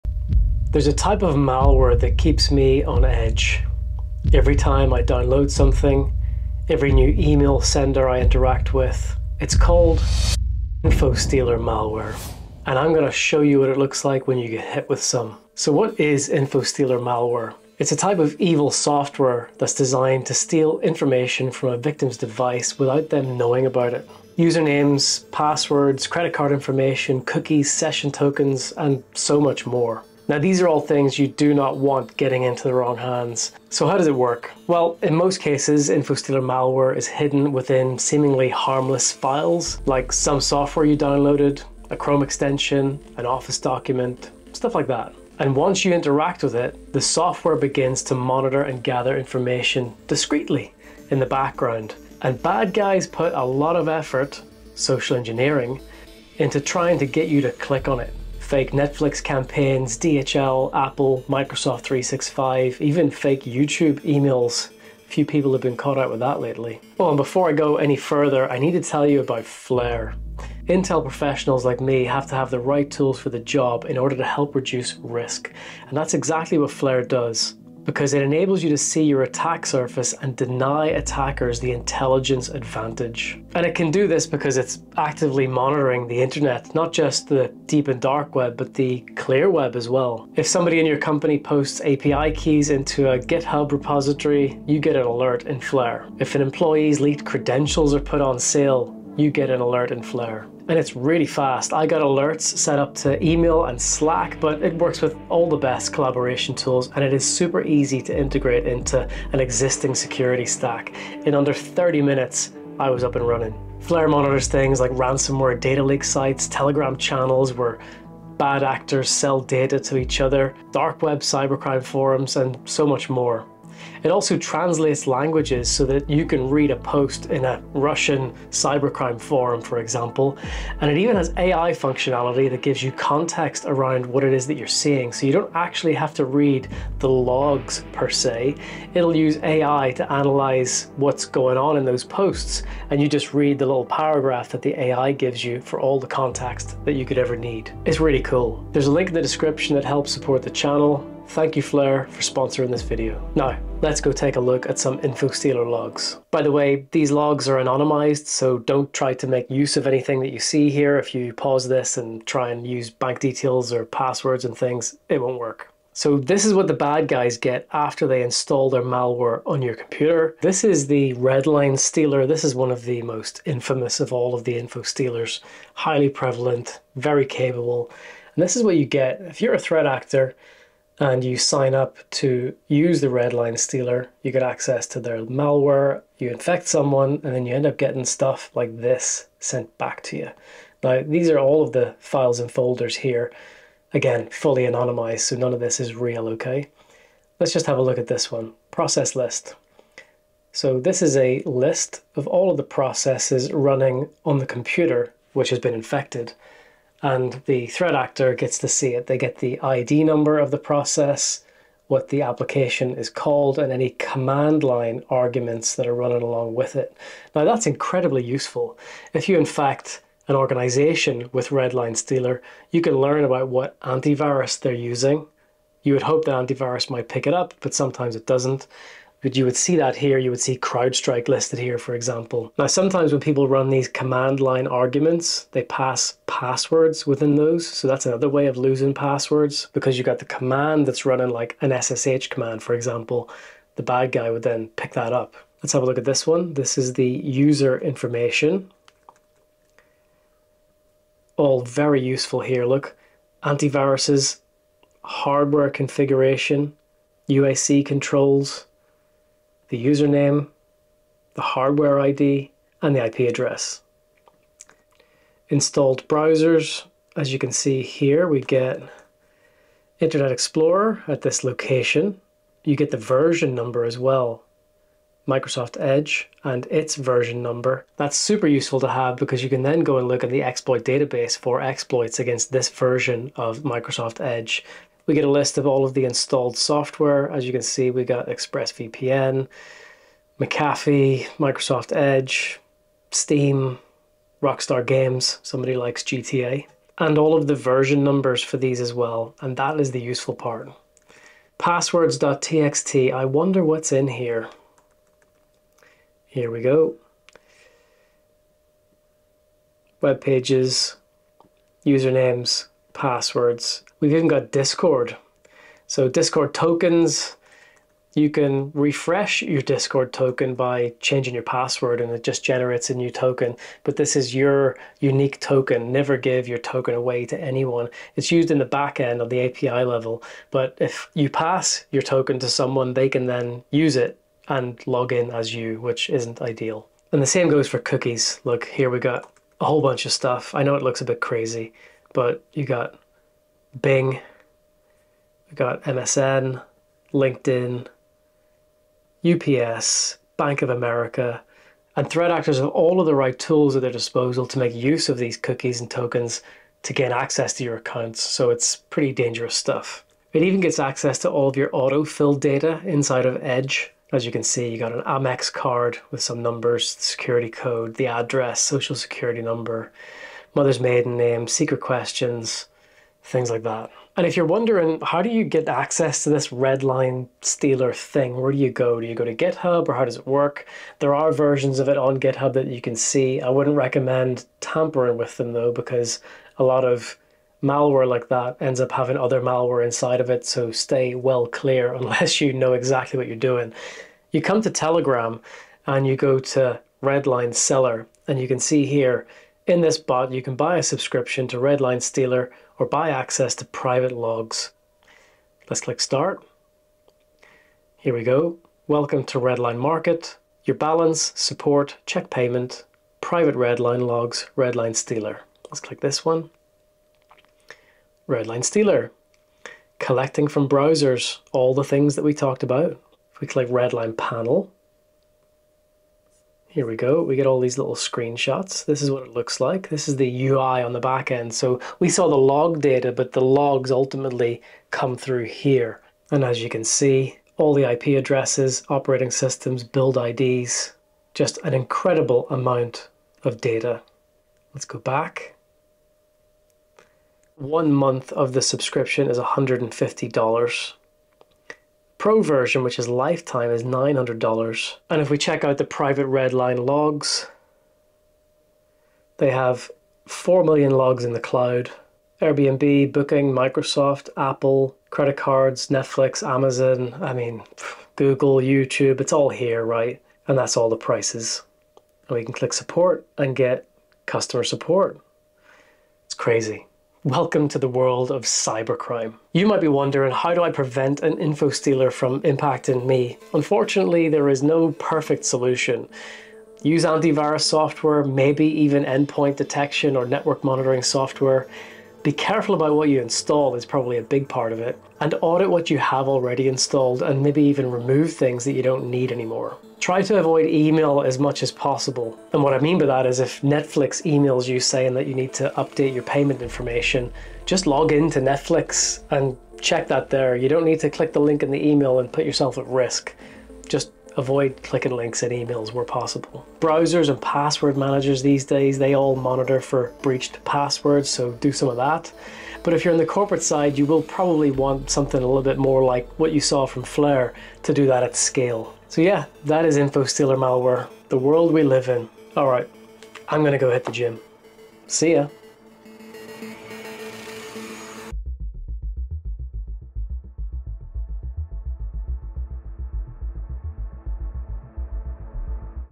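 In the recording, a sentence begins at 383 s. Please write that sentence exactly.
I wouldn't recommend tampering with them though, because a lot of malware like that ends up having other malware inside of it.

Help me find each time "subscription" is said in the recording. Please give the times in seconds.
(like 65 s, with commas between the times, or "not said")
400 s, 448 s.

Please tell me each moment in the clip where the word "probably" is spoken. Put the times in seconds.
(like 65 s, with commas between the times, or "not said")
493 s, 524 s.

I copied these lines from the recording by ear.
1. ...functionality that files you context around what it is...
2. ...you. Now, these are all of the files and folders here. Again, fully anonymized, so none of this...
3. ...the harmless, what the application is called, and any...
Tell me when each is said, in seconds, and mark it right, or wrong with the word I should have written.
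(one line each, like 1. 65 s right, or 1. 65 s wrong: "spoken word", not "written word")
1. 131 s wrong: "gives", not "files"
2. 190 s right
3. 210 s wrong: "process", not "harmless".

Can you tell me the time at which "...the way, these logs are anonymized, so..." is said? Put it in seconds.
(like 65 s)
156 s.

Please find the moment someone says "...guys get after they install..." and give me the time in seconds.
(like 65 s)
167 s.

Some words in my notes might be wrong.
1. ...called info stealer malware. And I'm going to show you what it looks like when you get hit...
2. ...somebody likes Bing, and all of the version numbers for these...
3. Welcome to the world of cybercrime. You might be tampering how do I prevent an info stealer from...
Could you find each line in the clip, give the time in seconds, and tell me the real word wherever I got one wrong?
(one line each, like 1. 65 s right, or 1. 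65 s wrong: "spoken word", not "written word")
1. 9 s right
2. 295 s wrong: "GTA", not "Bing"
3. 477 s wrong: "wondering", not "tampering".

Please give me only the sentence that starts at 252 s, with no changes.
Look, antiviruses, hardware configuration, UAC controls, the username, the hardware ID, and the IP address.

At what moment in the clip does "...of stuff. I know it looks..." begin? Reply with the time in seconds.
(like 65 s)
340 s.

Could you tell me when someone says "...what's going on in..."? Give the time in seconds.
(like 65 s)
140 s.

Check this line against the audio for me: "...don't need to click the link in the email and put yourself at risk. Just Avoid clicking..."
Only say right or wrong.
right.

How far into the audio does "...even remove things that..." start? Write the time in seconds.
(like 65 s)
497 s.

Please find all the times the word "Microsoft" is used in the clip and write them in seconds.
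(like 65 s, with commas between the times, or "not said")
61 s, 275 s, 283 s, 291 s, 463 s.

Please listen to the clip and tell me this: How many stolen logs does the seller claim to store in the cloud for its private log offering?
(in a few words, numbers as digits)
4 million.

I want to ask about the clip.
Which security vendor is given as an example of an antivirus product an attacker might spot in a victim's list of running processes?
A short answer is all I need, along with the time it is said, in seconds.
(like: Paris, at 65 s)
CrowdStrike, at 230 s.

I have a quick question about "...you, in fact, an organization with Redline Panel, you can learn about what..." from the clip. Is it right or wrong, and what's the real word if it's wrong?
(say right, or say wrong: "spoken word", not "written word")
wrong: "Stealer", not "Panel".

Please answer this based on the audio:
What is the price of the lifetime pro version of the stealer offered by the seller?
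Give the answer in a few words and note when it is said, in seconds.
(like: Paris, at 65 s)
$900, at 453 s.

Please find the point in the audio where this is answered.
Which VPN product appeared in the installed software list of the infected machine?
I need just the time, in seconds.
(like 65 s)
288 s.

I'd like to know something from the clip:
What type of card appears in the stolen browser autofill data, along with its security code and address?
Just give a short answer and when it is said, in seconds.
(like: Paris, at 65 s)
Amex, at 365 s.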